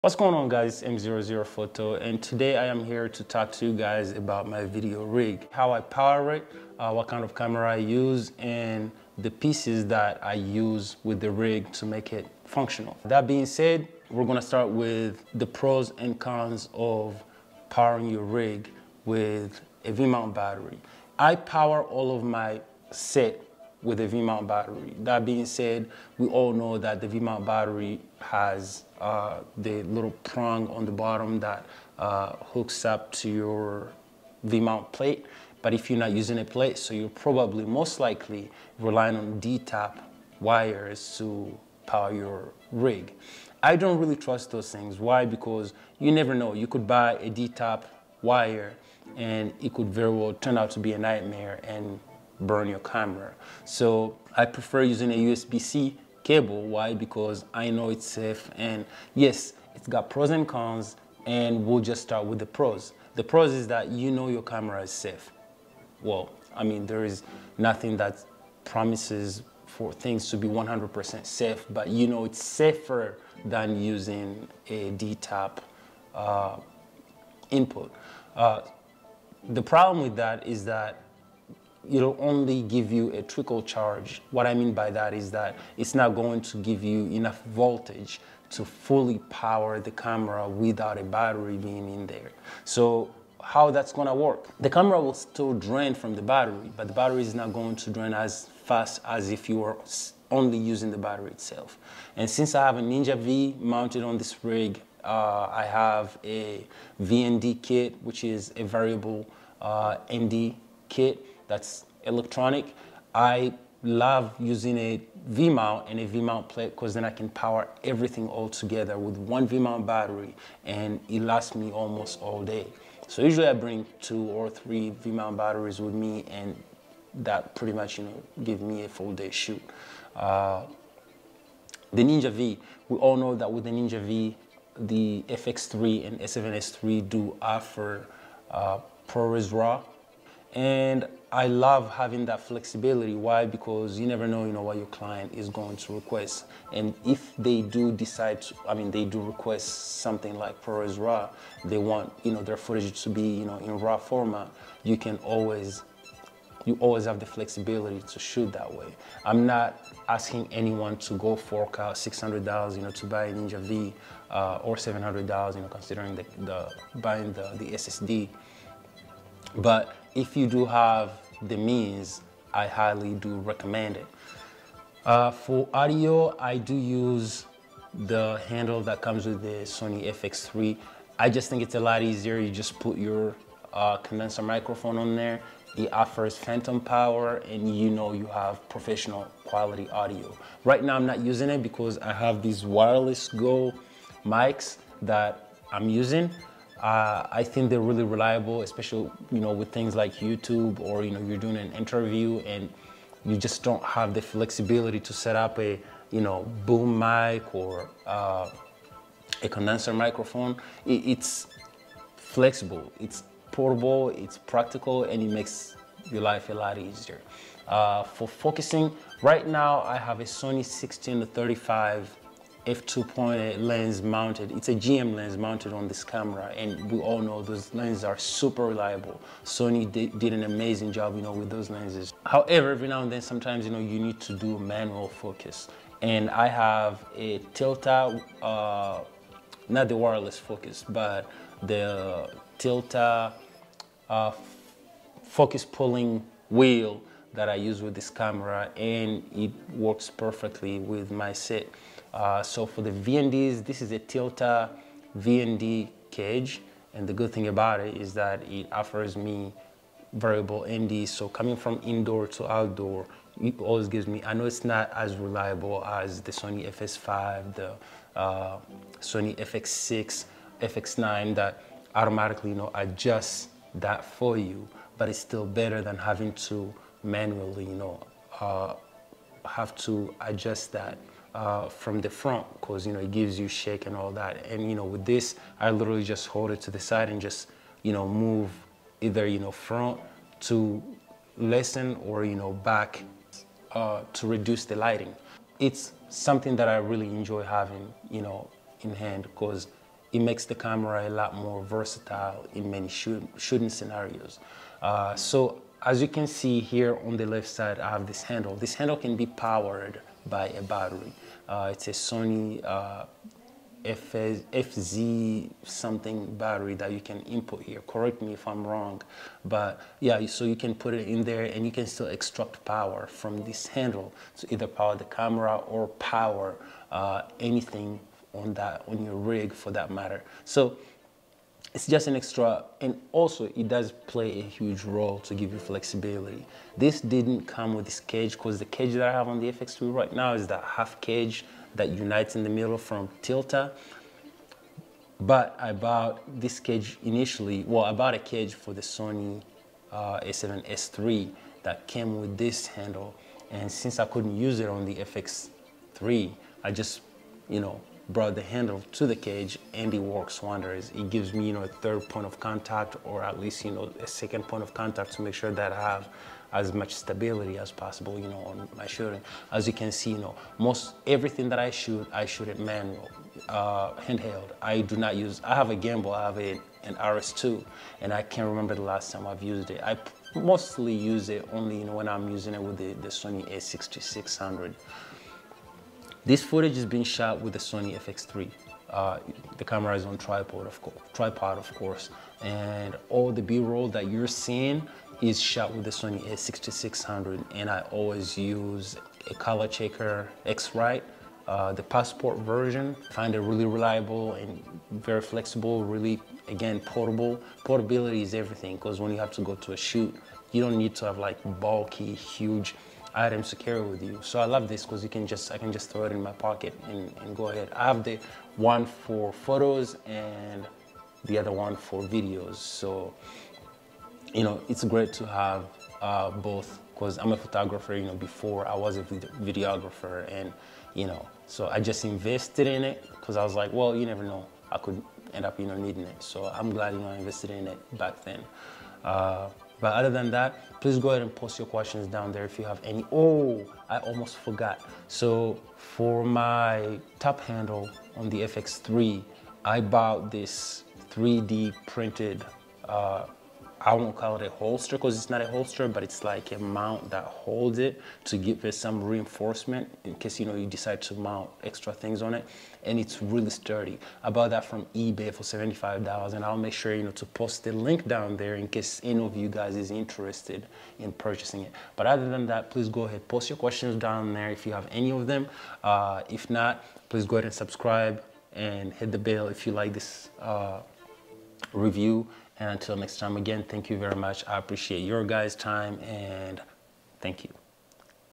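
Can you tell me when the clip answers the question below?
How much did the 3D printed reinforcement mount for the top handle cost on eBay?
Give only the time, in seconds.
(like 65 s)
465 s.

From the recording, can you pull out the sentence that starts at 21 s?
I power all of my set with a mount battery.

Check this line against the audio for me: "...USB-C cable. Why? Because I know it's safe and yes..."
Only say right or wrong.
right.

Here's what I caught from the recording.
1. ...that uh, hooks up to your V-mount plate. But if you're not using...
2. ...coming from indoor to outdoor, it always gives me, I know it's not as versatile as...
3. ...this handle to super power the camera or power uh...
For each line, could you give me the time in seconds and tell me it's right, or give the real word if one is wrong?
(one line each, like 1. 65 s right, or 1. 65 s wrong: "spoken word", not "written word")
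1. 31 s right
2. 261 s wrong: "reliable", not "versatile"
3. 323 s wrong: "either", not "super".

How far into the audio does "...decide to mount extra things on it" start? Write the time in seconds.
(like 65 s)
460 s.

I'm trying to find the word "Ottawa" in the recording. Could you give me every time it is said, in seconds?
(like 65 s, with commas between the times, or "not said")
not said.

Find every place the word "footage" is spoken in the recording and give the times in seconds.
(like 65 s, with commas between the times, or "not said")
152 s, 386 s.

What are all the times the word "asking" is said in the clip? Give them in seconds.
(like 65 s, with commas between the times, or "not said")
160 s.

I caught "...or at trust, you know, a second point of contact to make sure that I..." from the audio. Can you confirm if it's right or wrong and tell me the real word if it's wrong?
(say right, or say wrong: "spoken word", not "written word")
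wrong: "least", not "trust".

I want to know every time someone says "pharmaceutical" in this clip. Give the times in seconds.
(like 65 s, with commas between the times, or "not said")
not said.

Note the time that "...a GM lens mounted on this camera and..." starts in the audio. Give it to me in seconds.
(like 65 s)
224 s.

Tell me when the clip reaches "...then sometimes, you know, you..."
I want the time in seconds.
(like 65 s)
233 s.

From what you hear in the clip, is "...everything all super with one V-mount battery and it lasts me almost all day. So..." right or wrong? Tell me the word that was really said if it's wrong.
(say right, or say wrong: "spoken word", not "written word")
wrong: "together", not "super".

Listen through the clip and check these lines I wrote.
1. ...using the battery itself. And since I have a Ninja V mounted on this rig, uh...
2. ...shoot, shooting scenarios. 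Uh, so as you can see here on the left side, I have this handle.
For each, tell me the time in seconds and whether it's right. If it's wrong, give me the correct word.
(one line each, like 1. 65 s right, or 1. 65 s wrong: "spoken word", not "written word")
1. 100 s right
2. 302 s right.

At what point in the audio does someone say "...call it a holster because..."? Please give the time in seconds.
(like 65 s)
454 s.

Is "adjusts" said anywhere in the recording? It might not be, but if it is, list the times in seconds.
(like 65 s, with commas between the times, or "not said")
272 s, 280 s.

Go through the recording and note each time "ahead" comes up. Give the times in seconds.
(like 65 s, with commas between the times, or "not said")
417 s, 441 s, 473 s, 477 s.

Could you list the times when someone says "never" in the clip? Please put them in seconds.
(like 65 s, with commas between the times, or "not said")
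46 s, 144 s, 434 s.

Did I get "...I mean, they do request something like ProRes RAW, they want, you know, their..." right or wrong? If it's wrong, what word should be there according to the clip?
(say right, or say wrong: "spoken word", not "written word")
right.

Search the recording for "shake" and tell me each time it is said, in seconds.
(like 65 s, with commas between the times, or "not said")
283 s.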